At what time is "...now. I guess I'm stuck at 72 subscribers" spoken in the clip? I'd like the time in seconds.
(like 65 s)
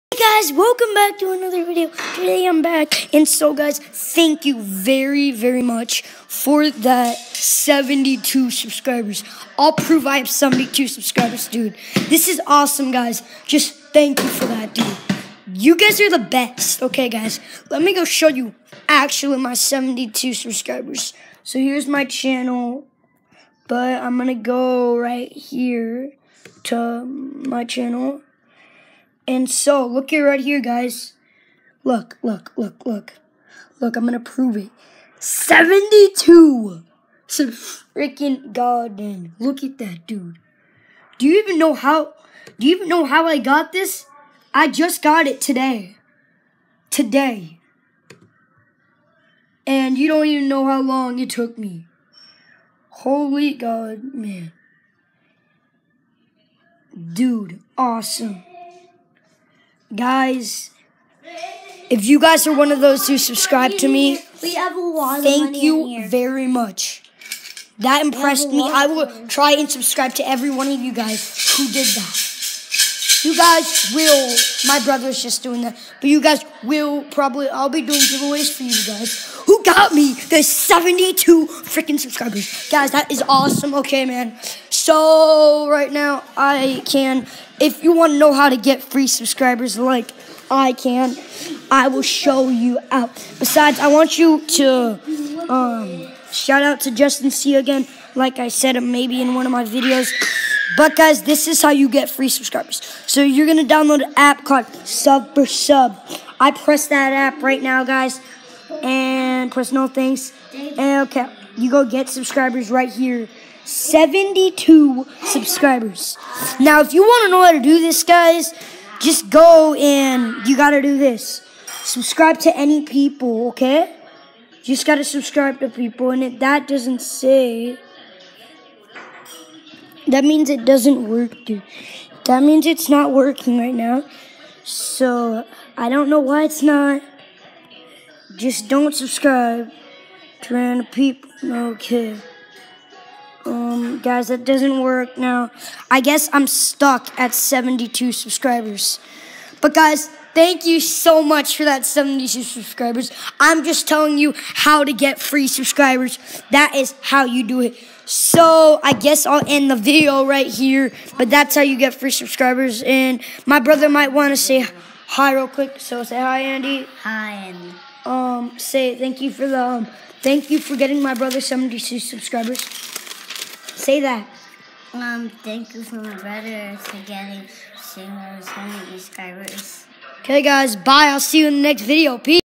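145 s.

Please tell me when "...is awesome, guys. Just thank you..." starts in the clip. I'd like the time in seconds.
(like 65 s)
12 s.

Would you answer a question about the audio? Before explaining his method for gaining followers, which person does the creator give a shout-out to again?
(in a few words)
Justin C.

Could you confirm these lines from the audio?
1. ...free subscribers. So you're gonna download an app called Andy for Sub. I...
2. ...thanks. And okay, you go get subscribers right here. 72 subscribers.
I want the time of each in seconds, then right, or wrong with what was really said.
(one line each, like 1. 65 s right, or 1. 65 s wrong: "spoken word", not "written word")
1. 102 s wrong: "Sub", not "Andy"
2. 109 s right.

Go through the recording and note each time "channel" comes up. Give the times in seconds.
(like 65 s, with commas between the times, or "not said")
22 s, 27 s.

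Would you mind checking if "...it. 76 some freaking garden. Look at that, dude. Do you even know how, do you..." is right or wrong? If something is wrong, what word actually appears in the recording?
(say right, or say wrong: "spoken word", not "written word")
wrong: "72", not "76".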